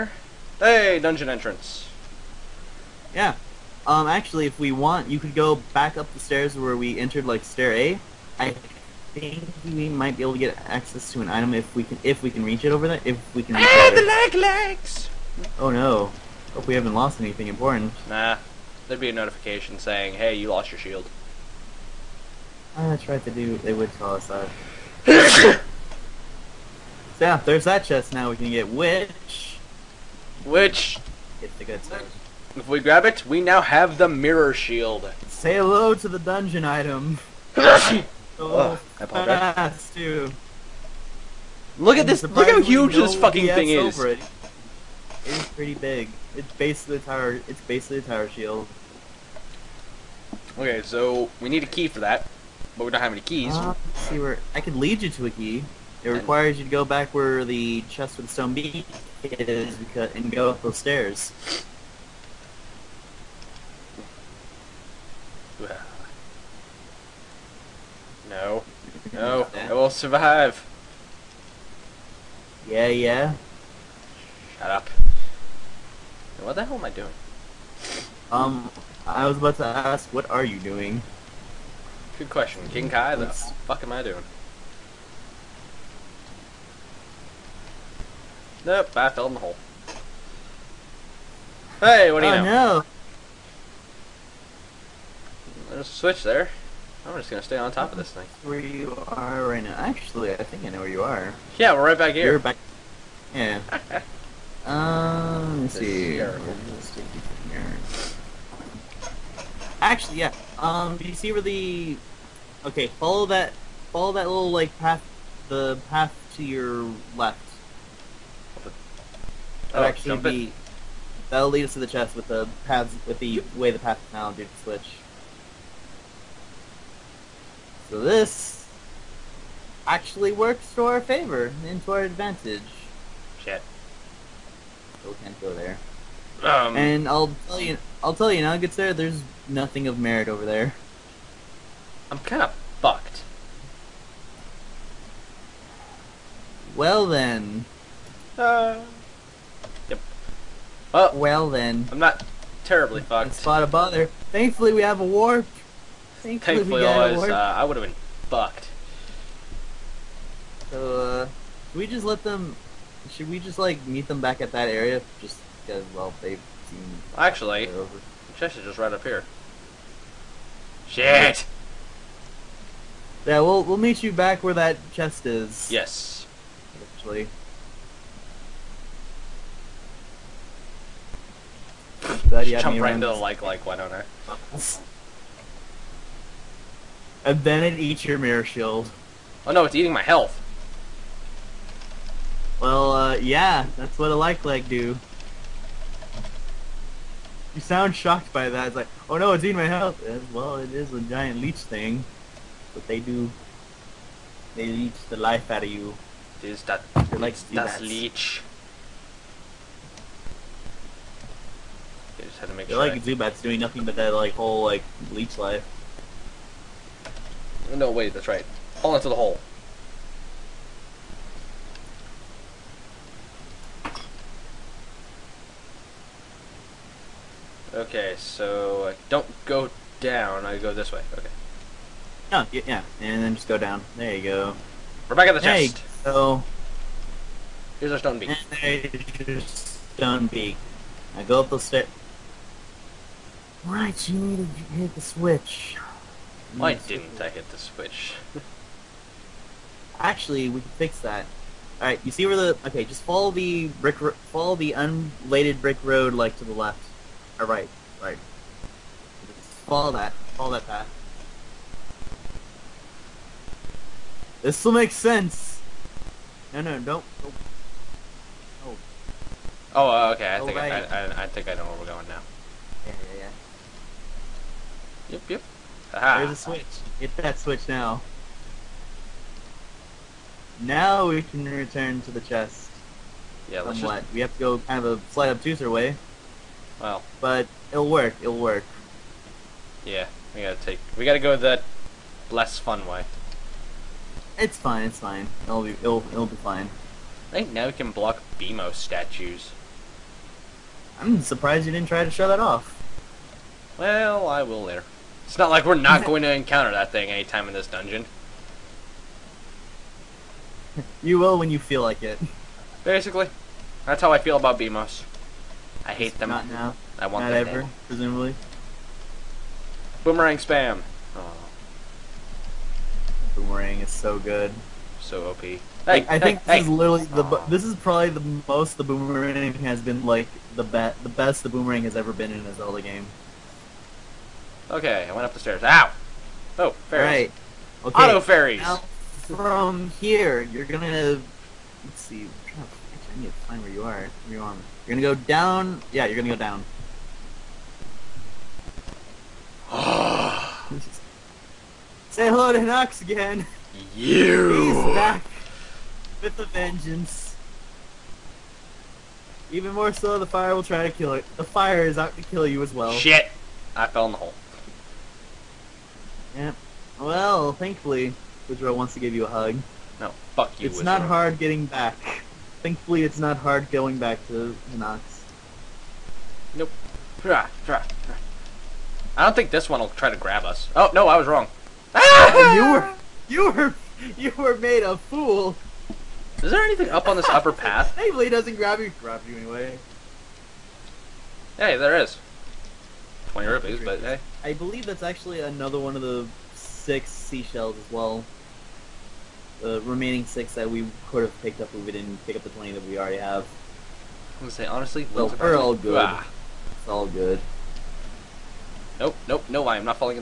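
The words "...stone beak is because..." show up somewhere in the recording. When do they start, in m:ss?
0:58.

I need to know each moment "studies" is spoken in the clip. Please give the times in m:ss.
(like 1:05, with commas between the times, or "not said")
not said.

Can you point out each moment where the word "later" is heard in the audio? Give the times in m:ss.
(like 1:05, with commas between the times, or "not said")
5:04.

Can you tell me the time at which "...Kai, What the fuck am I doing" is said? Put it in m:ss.
1:22.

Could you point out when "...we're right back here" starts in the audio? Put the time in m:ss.
1:41.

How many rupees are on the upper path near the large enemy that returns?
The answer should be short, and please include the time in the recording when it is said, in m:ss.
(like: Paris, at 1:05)
20, at 6:33.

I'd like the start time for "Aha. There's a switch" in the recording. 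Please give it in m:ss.
4:35.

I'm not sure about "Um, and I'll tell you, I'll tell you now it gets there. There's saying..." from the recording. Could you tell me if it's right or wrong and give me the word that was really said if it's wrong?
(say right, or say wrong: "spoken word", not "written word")
wrong: "nothing", not "saying".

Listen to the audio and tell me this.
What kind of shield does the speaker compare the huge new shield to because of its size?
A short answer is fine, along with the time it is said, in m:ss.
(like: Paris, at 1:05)
Tower shield, at 0:48.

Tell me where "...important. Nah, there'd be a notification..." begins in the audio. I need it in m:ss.
0:17.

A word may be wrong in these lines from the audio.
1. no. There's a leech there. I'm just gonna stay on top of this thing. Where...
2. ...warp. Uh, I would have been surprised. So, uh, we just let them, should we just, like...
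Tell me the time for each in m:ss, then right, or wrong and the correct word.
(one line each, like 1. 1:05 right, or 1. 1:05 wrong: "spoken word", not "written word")
1. 1:32 wrong: "switch", not "leech"
2. 2:37 wrong: "fucked", not "surprised".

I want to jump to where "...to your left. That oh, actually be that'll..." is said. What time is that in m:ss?
1:56.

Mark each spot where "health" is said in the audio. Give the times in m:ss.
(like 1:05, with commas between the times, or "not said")
3:10, 3:19.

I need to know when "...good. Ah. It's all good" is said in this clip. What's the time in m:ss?
6:45.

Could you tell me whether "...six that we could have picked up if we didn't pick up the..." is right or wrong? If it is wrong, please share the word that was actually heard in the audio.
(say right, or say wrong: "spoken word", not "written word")
right.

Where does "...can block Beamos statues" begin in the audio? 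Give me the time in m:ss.
4:57.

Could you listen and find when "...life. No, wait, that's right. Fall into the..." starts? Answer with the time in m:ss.
3:35.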